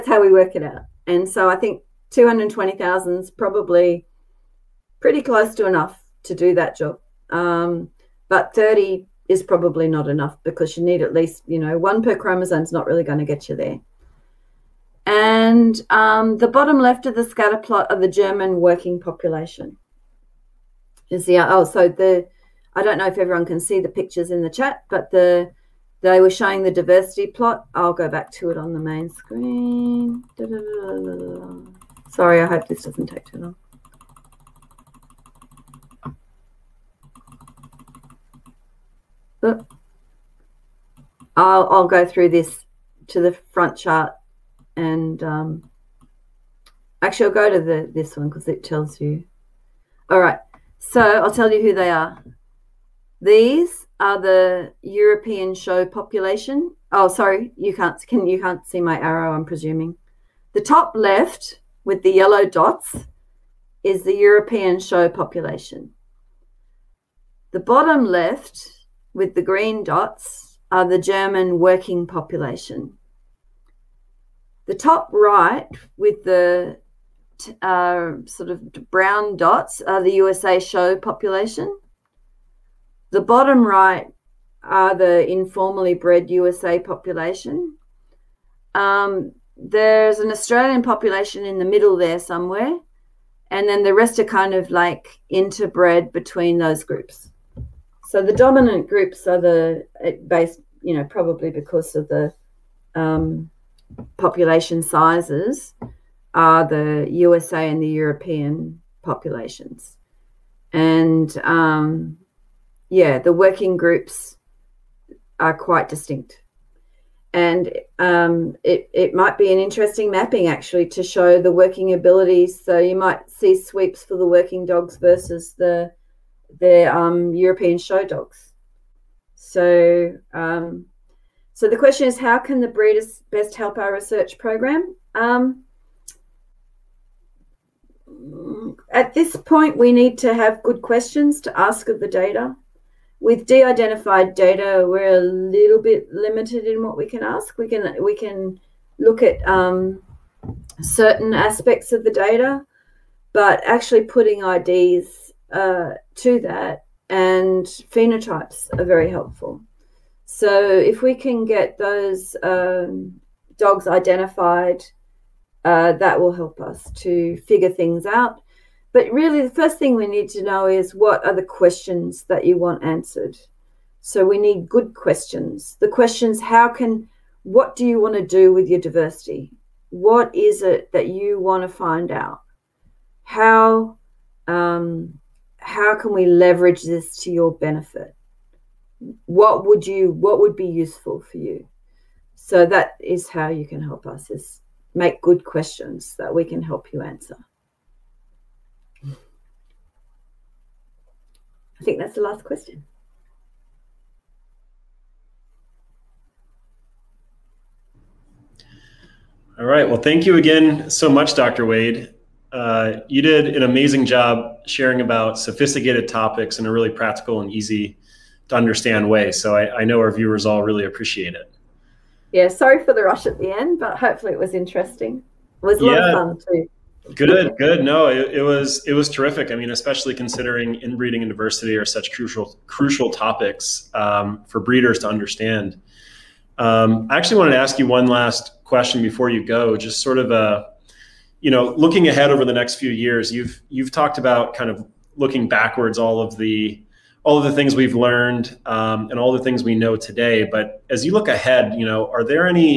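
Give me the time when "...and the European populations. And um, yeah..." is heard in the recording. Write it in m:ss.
1:47.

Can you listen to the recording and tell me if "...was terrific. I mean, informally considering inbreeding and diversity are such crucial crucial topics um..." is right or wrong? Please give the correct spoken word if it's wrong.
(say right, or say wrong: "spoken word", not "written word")
wrong: "especially", not "informally".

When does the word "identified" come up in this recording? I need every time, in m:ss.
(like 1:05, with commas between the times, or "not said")
2:23, 2:43.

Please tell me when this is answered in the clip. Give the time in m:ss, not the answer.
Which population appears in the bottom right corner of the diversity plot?
1:25.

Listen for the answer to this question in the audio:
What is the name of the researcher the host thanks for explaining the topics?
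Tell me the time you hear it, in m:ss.
3:31.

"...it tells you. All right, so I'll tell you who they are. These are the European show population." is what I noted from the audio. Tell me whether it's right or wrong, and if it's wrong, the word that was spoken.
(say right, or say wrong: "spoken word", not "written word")
right.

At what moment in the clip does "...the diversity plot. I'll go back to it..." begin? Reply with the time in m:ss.
0:26.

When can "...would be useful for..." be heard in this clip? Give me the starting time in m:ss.
3:10.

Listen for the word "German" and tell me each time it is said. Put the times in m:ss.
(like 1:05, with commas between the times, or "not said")
0:18, 1:10.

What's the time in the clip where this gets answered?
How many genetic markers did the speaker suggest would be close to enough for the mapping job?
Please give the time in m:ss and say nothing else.
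0:02.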